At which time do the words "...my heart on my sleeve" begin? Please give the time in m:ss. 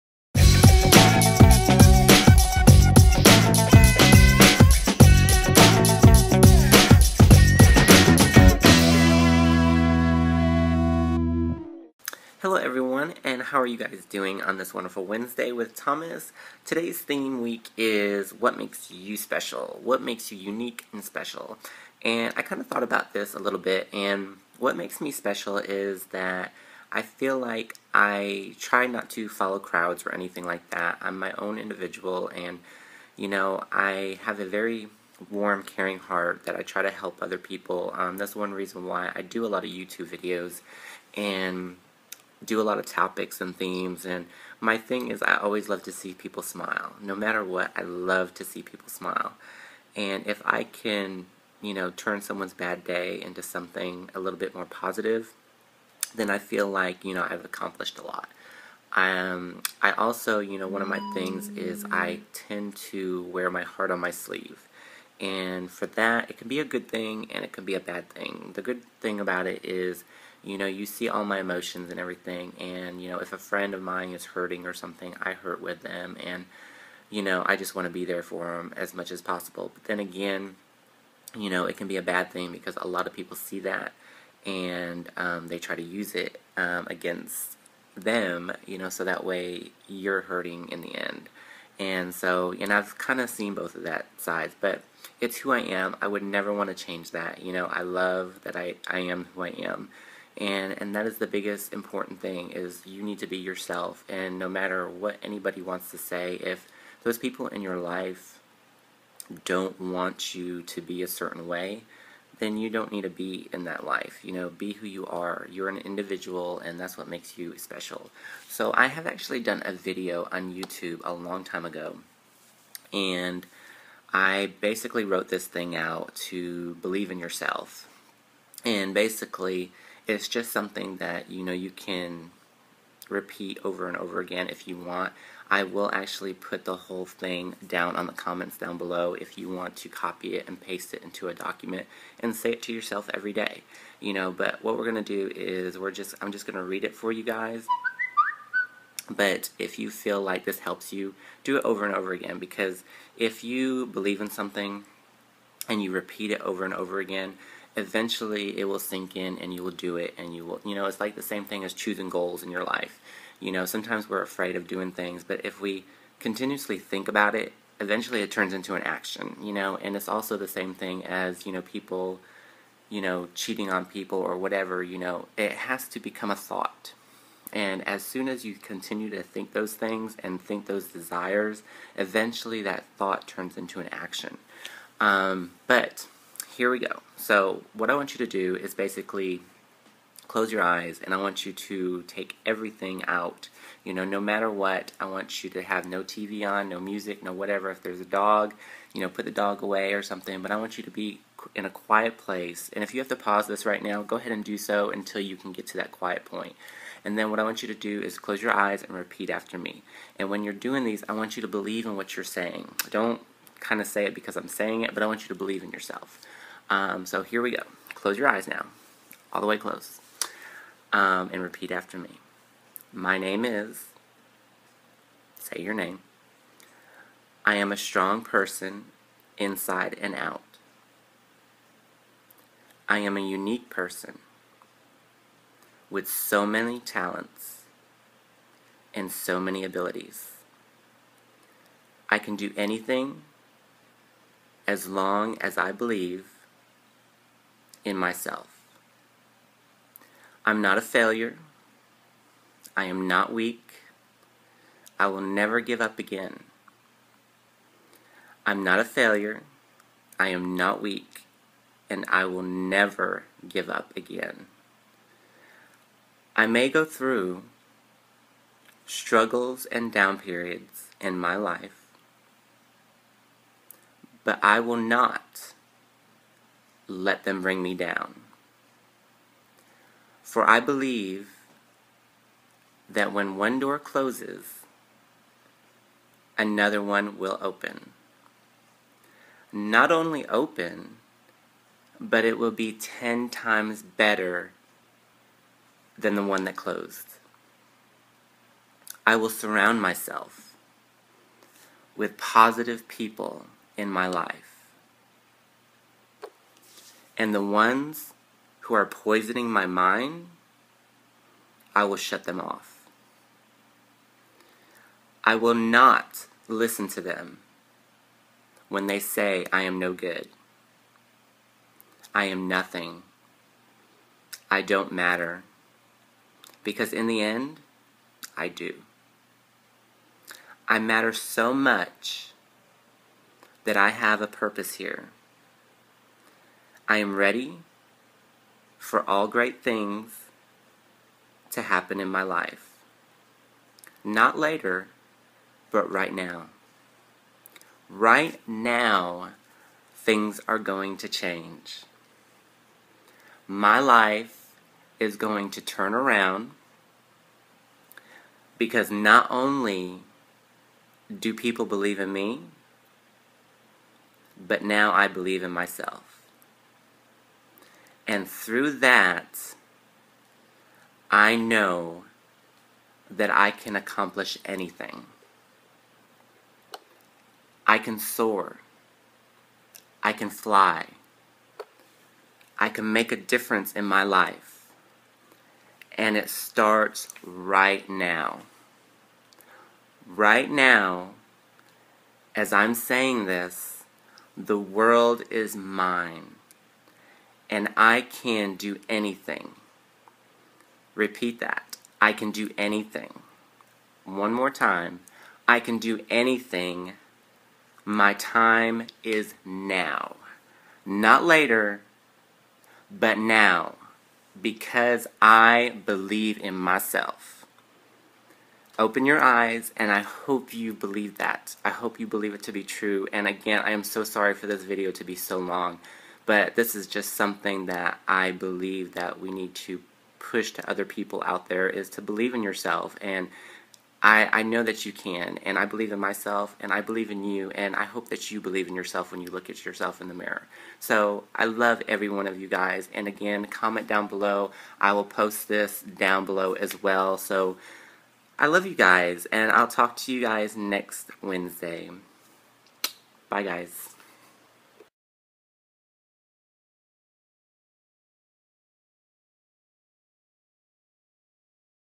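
1:03.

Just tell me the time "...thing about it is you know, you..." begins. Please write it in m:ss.
1:08.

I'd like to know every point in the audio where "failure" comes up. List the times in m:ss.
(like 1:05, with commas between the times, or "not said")
4:10, 4:18.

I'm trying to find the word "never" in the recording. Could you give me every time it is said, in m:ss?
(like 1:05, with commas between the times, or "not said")
1:36, 4:15, 4:22.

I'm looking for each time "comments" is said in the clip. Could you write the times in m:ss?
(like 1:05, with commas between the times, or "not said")
2:18, 7:23.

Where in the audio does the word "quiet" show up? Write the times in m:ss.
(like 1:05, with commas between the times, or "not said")
3:21, 3:25.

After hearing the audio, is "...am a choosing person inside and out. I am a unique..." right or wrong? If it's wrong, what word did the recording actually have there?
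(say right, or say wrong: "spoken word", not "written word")
wrong: "strong", not "choosing".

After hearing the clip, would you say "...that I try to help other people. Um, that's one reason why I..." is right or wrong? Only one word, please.
right.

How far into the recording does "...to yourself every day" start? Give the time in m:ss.
2:22.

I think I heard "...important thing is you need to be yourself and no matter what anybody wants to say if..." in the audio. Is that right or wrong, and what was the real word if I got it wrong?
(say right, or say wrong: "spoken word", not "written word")
right.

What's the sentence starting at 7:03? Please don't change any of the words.
And again, I am so sorry for this video to be so long.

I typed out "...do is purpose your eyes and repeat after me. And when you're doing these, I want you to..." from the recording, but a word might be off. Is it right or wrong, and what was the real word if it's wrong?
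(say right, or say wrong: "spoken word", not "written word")
wrong: "close", not "purpose".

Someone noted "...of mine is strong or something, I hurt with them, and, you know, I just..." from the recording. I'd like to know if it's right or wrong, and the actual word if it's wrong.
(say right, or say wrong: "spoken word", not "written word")
wrong: "hurting", not "strong".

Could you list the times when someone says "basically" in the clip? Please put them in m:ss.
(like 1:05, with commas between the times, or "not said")
2:04, 2:08, 3:08.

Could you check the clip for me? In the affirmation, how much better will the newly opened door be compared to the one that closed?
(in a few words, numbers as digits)
10 times better.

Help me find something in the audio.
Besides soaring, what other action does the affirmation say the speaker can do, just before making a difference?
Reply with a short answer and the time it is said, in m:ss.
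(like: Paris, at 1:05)
Fly, at 6:20.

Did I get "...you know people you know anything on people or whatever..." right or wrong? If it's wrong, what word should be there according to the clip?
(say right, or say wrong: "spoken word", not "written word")
wrong: "cheating", not "anything".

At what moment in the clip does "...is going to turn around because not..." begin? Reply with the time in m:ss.
5:54.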